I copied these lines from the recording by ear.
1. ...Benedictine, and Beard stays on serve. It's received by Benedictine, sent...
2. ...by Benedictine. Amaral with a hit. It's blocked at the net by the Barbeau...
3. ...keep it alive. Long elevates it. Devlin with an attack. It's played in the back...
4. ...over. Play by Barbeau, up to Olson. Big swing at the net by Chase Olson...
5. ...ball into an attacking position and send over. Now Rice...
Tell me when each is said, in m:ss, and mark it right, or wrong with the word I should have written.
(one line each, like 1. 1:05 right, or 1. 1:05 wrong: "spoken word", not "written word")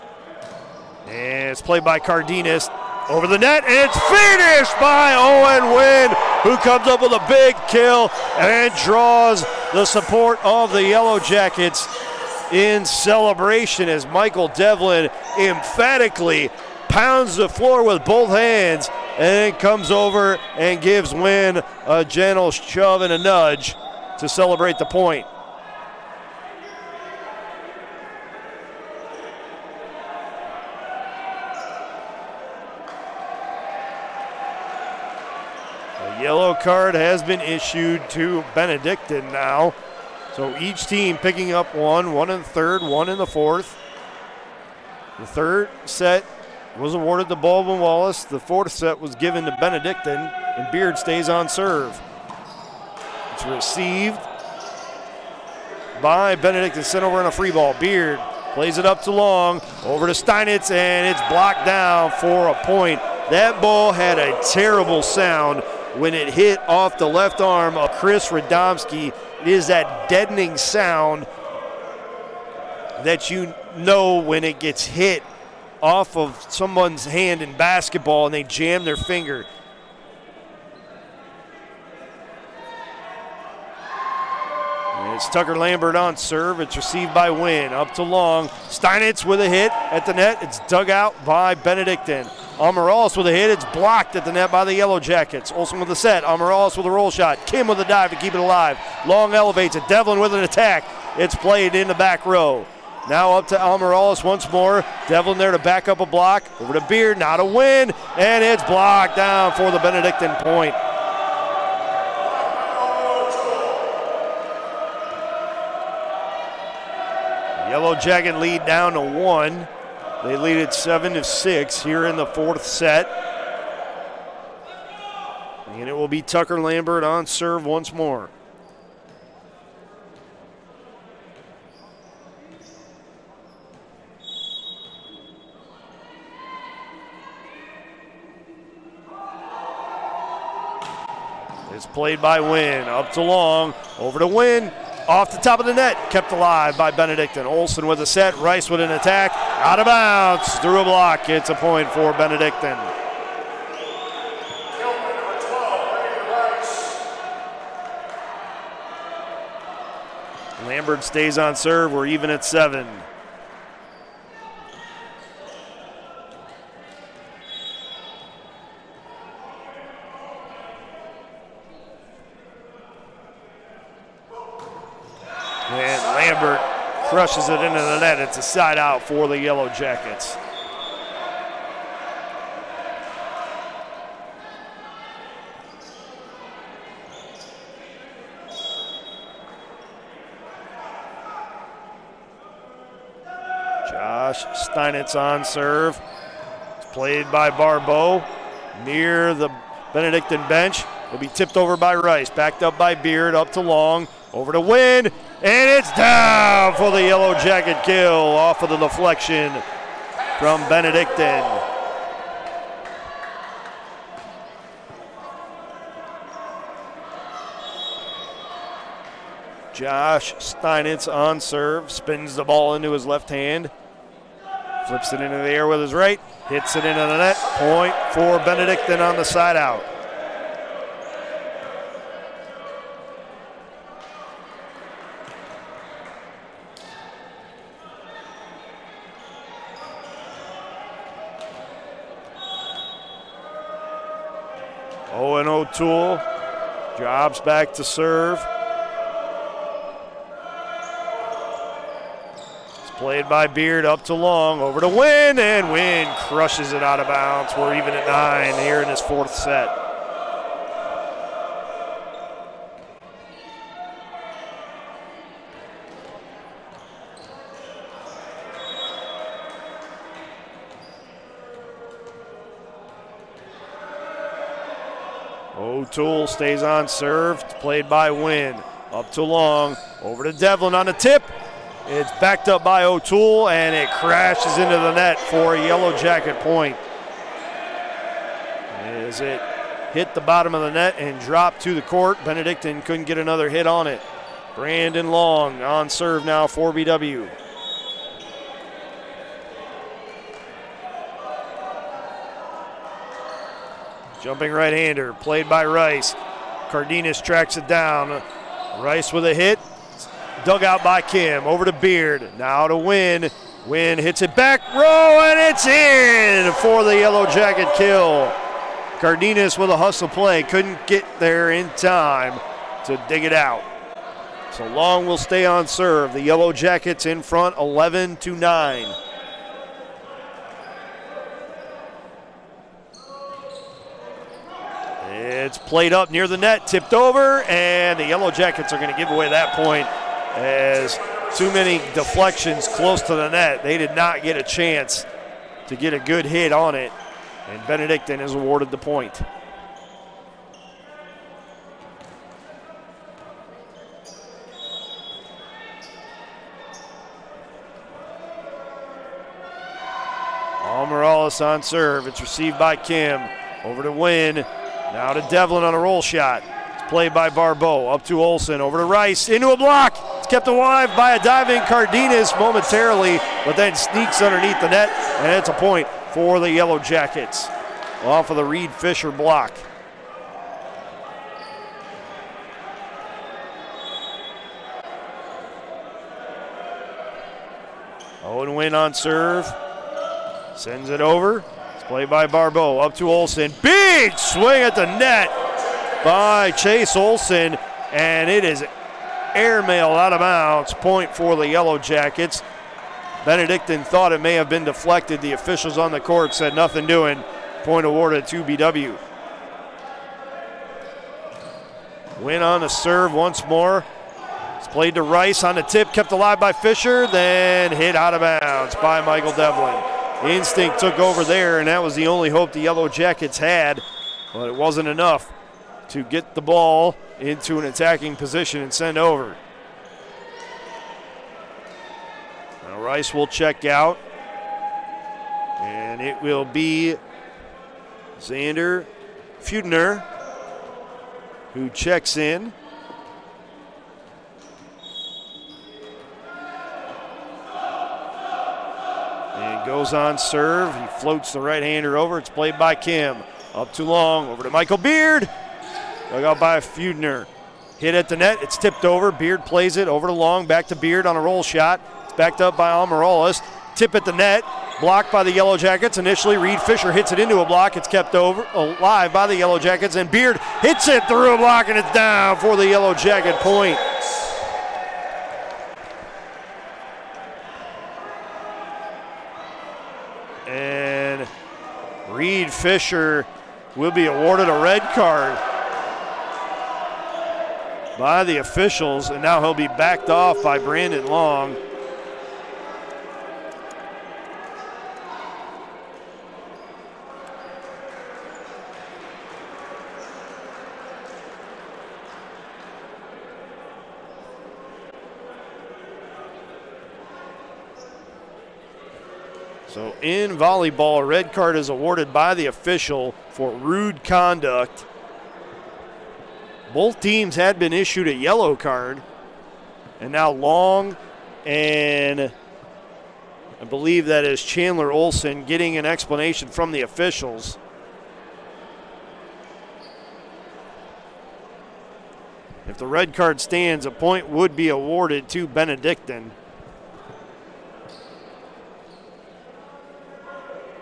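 1. 0:49 right
2. 1:31 wrong: "Yellow", not "Barbeau"
3. 1:38 right
4. 6:30 right
5. 7:06 right.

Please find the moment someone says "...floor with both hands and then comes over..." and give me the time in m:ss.
0:17.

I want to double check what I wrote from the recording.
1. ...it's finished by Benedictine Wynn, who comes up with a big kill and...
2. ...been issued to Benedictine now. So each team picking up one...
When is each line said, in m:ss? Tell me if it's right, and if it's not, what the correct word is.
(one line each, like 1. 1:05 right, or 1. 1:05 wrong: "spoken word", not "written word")
1. 0:03 wrong: "Owen", not "Benedictine"
2. 0:37 right.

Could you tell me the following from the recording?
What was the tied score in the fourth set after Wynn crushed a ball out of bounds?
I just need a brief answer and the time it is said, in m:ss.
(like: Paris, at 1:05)
9, at 4:18.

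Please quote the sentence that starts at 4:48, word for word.
As it hit the bottom of the net and dropped to the court, Benedictine couldn't get another hit on it.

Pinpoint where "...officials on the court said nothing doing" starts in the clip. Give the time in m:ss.
6:45.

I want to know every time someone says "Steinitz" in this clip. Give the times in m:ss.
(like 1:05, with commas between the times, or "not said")
1:00, 1:28, 3:14, 3:40.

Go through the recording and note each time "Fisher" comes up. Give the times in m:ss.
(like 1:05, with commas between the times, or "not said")
6:18, 6:56, 7:46, 8:02.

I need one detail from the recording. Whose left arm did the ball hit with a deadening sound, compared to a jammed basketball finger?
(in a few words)
Chris Radomski.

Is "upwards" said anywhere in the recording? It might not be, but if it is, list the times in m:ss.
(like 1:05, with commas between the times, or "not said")
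not said.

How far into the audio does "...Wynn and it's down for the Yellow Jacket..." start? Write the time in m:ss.
3:24.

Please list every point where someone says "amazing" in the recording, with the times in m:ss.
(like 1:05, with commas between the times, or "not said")
not said.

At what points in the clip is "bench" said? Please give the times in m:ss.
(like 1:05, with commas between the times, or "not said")
3:20.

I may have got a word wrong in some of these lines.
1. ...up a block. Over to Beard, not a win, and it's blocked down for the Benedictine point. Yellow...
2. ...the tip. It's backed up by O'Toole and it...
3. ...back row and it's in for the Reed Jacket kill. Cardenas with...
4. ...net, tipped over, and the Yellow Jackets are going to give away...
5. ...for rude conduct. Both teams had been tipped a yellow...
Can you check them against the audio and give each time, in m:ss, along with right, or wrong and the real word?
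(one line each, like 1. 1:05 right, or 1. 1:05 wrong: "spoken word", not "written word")
1. 1:45 right
2. 4:40 right
3. 5:14 wrong: "Yellow", not "Reed"
4. 5:36 right
5. 8:33 wrong: "issued", not "tipped".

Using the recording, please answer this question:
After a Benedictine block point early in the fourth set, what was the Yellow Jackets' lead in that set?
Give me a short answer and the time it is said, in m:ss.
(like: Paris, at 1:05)
7 to 6, at 2:00.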